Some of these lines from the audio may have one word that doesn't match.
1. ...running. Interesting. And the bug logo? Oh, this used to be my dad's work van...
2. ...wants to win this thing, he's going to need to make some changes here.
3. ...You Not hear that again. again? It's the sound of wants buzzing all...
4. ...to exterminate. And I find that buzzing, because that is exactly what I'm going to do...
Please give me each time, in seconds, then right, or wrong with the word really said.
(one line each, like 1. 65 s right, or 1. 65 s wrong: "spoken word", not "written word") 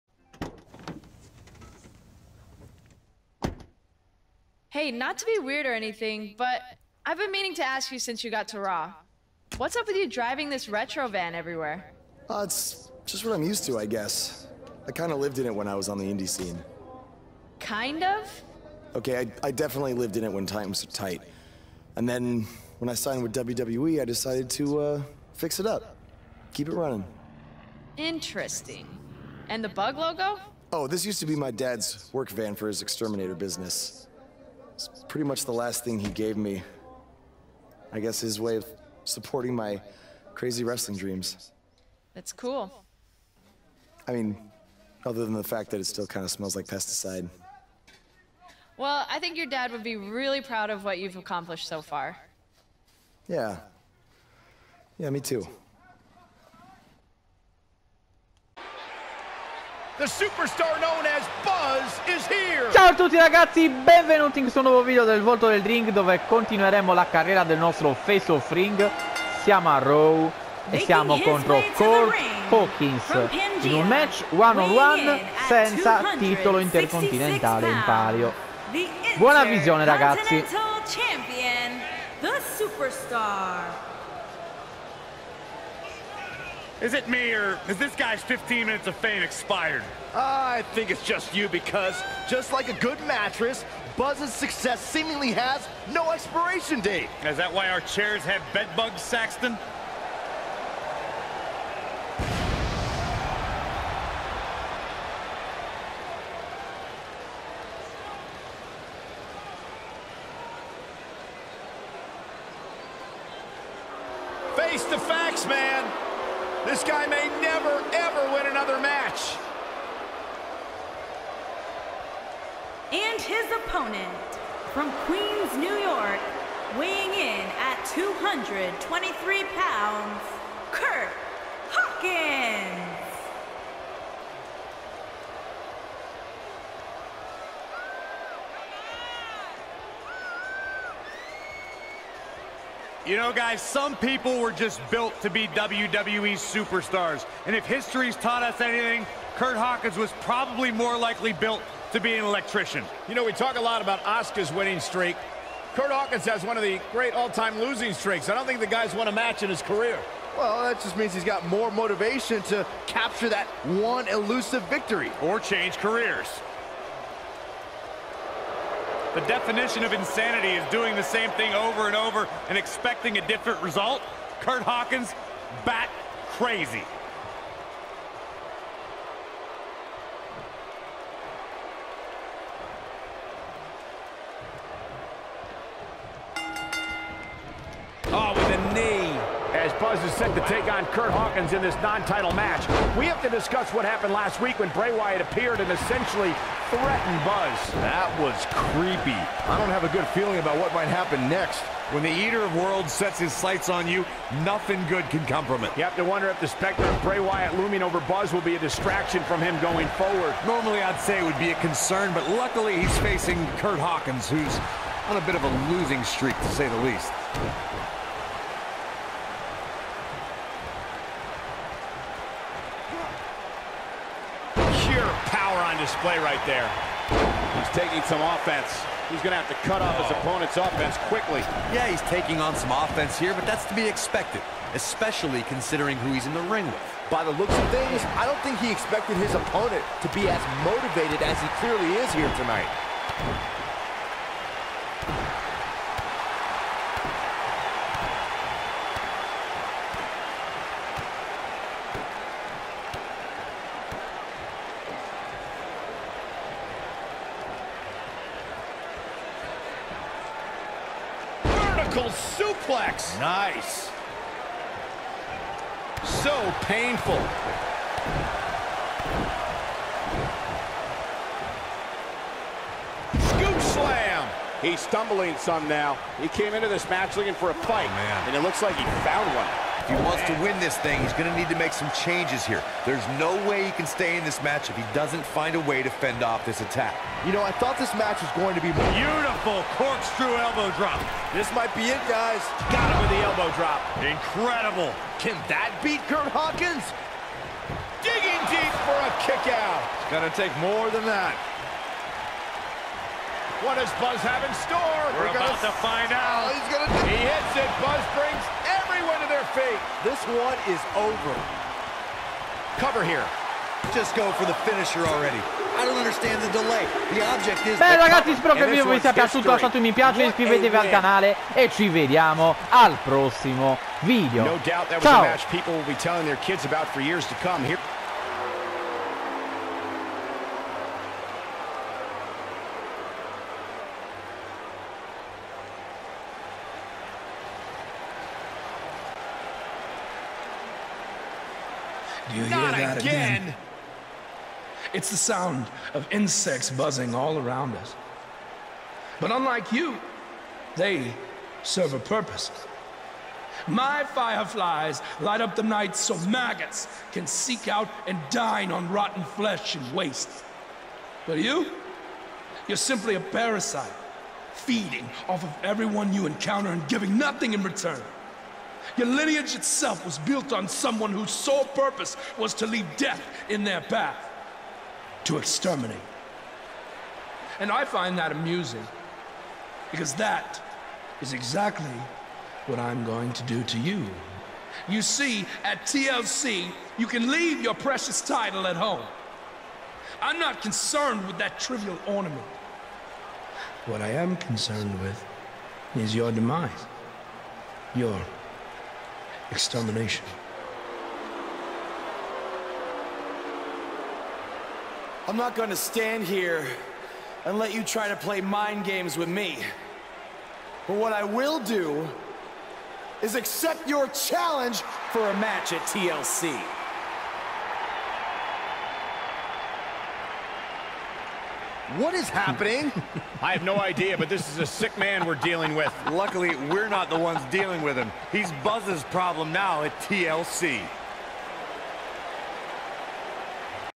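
1. 26 s right
2. 280 s right
3. 342 s wrong: "insects", not "wants"
4. 375 s wrong: "amusing", not "buzzing".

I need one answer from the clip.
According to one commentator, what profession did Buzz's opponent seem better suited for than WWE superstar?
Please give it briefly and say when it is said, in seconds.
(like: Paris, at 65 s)
Electrician, at 152 s.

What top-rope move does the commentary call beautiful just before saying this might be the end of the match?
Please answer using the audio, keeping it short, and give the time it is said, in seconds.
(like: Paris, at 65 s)
Corkscrew elbow drop, at 289 s.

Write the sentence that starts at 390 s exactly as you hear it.
I'm not concerned with that trivial ornament.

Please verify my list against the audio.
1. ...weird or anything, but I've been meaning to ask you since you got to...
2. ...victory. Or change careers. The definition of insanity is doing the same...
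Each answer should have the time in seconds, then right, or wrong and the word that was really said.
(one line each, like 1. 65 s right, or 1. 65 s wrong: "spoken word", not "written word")
1. 5 s right
2. 164 s right.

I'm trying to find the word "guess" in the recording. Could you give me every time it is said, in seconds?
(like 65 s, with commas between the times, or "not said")
13 s, 37 s.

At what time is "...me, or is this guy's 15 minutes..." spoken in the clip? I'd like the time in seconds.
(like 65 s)
87 s.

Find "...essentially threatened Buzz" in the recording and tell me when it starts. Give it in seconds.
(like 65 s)
195 s.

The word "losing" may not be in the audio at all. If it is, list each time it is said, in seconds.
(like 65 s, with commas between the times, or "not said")
157 s, 215 s.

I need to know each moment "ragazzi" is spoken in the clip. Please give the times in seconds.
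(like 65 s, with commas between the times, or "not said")
63 s, 79 s, 317 s.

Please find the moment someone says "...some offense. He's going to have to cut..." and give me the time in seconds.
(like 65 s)
228 s.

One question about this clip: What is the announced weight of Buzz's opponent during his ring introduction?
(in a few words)
223 pounds.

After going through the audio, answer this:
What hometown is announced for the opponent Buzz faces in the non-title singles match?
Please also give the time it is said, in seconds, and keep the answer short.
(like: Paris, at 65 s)
Queens, New York, at 125 s.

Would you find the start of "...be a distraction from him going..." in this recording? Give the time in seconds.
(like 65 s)
208 s.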